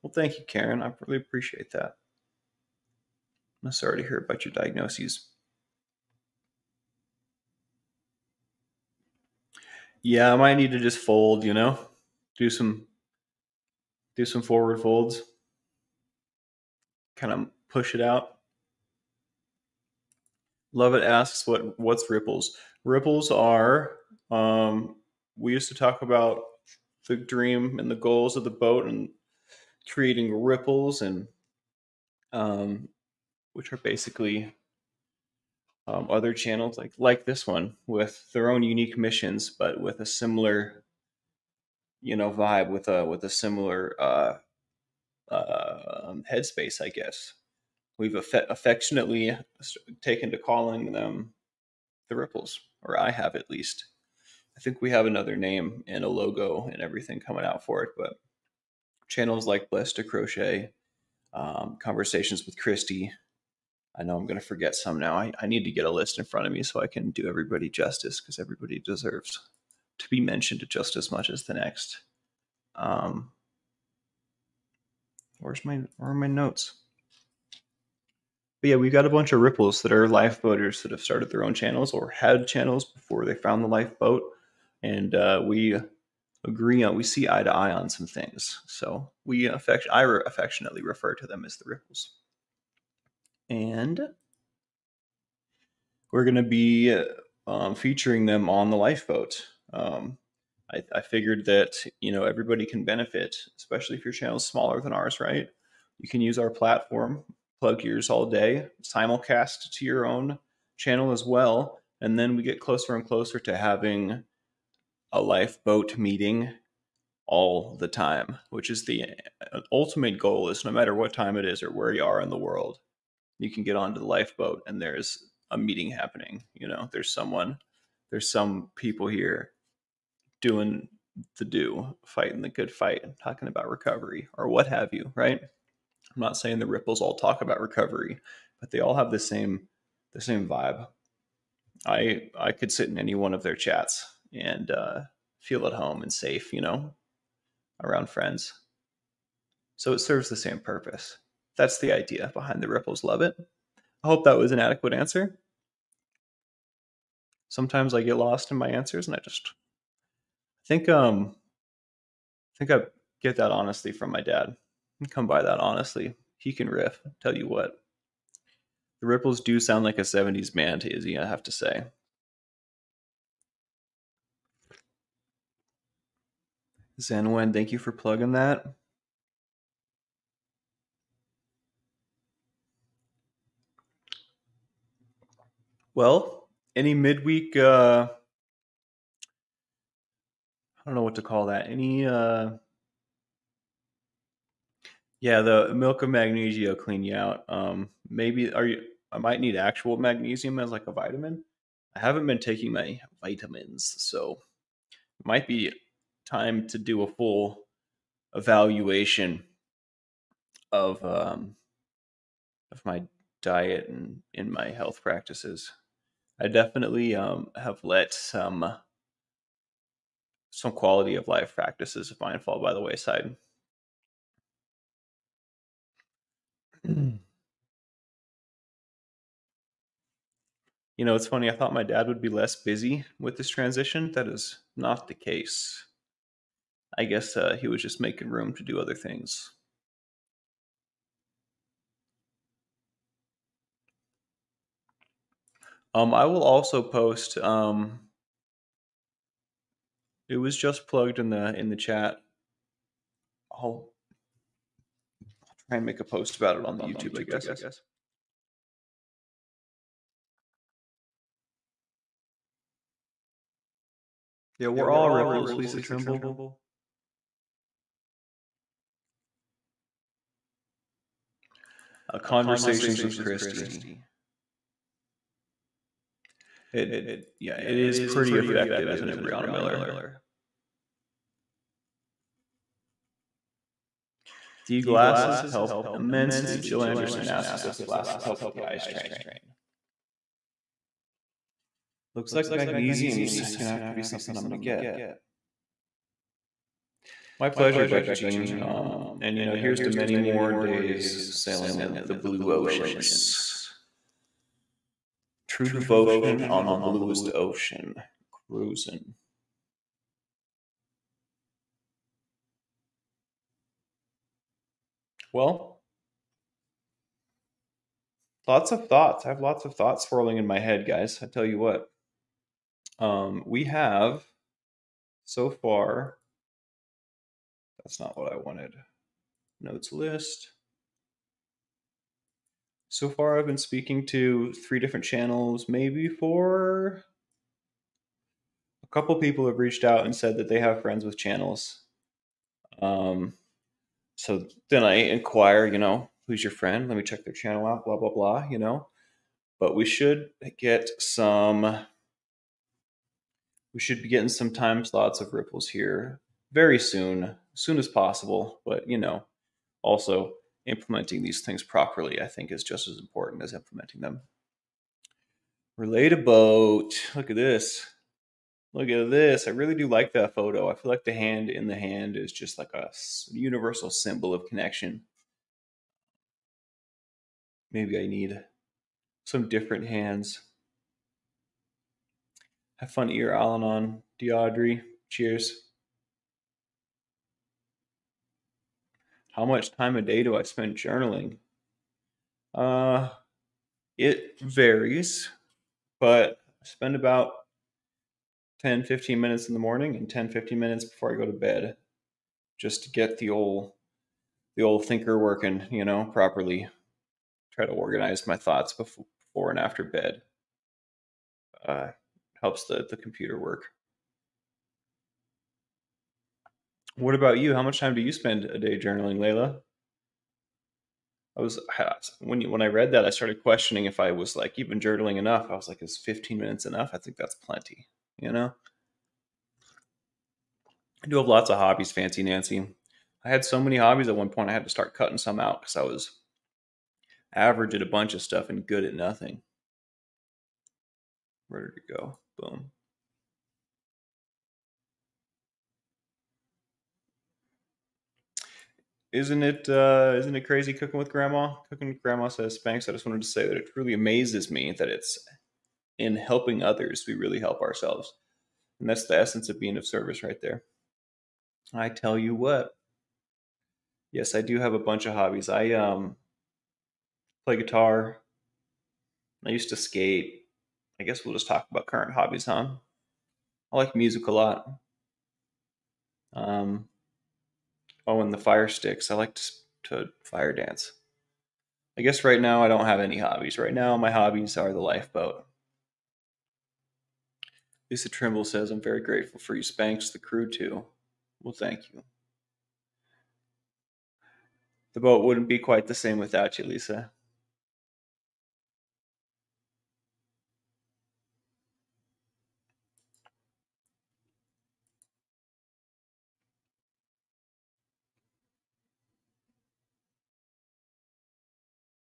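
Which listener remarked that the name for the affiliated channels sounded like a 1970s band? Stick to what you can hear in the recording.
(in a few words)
Izzy.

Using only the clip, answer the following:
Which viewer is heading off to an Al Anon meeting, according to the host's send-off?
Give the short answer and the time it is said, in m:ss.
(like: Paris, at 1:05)
Deaudrey, at 6:24.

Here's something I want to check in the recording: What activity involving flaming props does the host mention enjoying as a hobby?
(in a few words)
fire dance.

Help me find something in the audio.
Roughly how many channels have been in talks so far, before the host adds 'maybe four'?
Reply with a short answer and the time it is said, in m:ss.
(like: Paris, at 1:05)
3, at 5:34.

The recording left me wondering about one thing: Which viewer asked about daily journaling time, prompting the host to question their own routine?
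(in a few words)
Layla.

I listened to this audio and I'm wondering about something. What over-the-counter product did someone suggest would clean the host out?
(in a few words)
milk of magnesia.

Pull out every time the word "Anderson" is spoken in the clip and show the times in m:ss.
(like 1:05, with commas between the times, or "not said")
4:46.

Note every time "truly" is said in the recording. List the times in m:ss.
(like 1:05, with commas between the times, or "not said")
7:33.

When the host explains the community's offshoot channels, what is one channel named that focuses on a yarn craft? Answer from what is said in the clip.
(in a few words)
Blessed to Crochet.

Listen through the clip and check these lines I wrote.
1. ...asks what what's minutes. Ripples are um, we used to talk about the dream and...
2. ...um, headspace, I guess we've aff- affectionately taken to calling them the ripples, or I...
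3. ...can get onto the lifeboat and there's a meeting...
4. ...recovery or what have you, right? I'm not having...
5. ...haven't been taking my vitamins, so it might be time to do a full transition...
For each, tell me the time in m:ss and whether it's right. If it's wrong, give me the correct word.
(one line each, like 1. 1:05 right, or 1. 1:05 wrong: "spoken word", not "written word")
1. 0:21 wrong: "ripples", not "minutes"
2. 0:46 right
3. 2:03 right
4. 2:13 wrong: "saying", not "having"
5. 3:22 wrong: "evaluation", not "transition".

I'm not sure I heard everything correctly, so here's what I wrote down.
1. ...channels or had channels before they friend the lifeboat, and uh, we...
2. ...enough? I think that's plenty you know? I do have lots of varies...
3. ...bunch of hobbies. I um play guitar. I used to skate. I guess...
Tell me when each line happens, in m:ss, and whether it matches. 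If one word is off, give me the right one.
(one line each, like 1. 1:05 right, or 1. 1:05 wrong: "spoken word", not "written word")
1. 1:21 wrong: "found", not "friend"
2. 7:06 wrong: "hobbies", not "varies"
3. 7:44 right.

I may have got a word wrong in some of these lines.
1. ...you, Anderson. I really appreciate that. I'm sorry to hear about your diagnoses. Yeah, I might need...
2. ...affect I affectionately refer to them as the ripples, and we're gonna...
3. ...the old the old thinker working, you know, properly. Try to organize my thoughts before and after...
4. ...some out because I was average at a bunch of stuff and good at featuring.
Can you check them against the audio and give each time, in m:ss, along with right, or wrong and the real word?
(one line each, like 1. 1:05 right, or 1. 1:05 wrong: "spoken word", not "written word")
1. 0:00 wrong: "Karen", not "Anderson"
2. 1:29 right
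3. 6:43 right
4. 7:15 wrong: "nothing", not "featuring".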